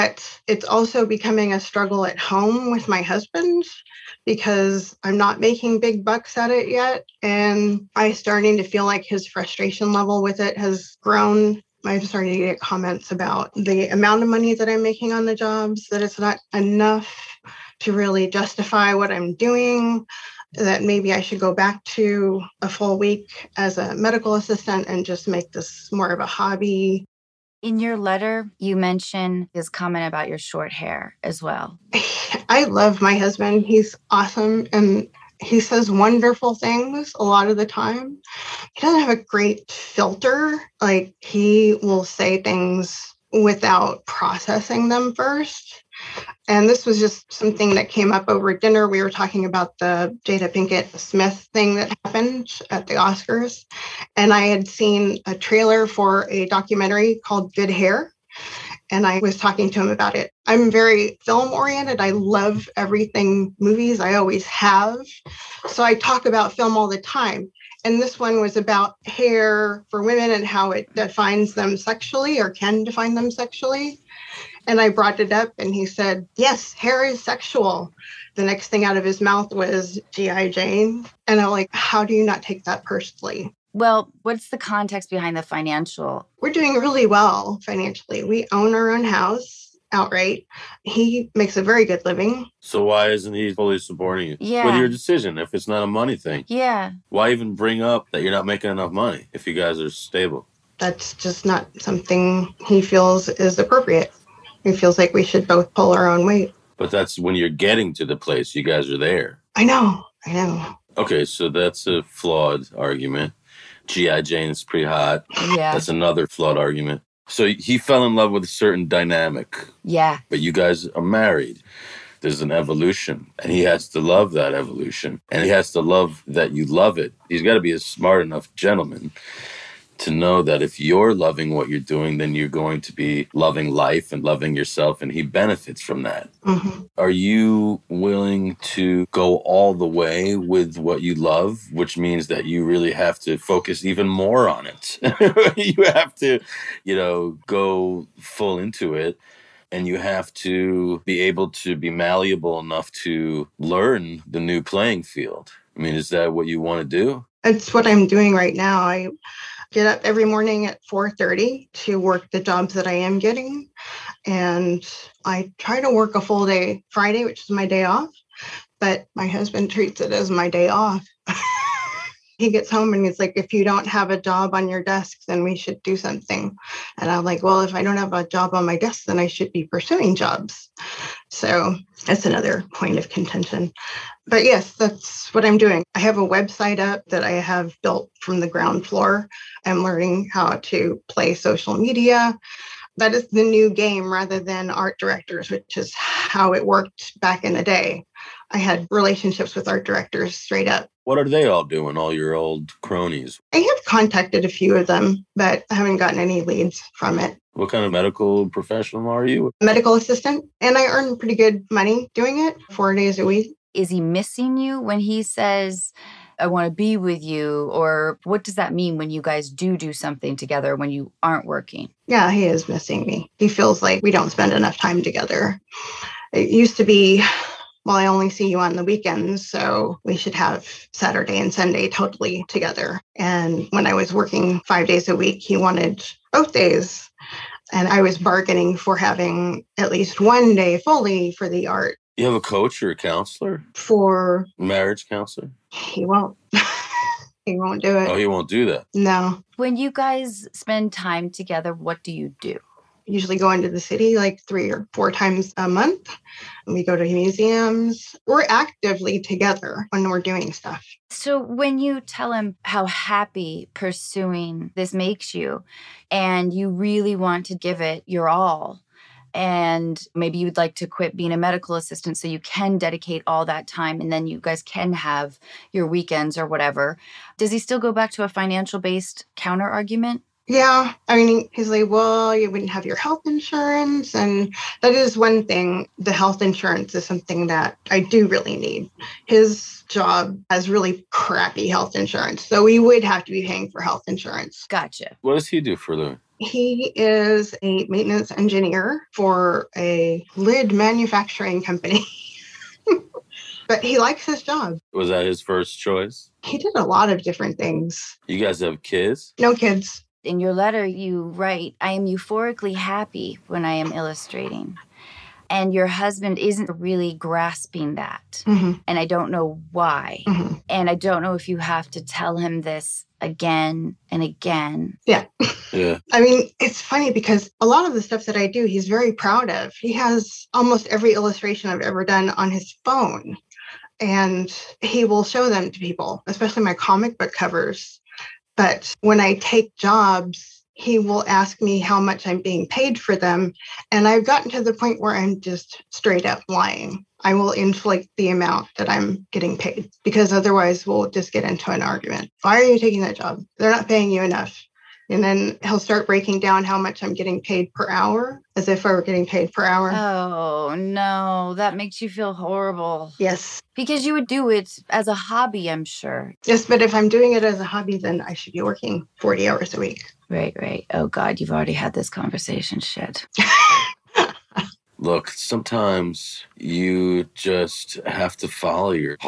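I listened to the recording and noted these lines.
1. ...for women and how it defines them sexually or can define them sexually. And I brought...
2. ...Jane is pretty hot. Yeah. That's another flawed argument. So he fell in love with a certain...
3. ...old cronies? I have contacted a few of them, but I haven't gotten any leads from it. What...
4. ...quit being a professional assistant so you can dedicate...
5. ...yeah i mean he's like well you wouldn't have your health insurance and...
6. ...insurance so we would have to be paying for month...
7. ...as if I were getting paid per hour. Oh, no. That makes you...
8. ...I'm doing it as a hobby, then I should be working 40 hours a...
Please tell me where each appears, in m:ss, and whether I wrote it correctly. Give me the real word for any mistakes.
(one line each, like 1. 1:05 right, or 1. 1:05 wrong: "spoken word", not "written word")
1. 1:09 right
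2. 1:54 right
3. 3:22 right
4. 4:30 wrong: "medical", not "professional"
5. 4:40 right
6. 4:51 wrong: "health", not "month"
7. 5:58 right
8. 6:06 right.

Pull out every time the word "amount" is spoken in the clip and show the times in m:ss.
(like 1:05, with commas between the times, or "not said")
0:13, 5:48.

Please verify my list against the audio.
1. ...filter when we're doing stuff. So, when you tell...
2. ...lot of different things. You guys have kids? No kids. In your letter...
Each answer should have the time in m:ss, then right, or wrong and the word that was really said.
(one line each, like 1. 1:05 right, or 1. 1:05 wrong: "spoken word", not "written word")
1. 4:19 wrong: "together", not "filter"
2. 5:06 right.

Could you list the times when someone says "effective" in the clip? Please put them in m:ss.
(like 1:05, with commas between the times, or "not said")
not said.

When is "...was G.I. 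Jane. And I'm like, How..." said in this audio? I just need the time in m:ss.
1:19.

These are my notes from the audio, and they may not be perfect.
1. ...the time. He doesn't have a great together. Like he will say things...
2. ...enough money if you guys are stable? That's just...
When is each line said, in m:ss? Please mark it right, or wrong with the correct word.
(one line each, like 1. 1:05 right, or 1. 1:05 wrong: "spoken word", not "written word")
1. 0:37 wrong: "filter", not "together"
2. 1:38 right.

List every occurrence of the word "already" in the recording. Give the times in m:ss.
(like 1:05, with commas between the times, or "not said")
6:11.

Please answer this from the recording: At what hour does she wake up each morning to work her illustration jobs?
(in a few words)
4:30.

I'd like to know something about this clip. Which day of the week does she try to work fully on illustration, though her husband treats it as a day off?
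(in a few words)
Friday.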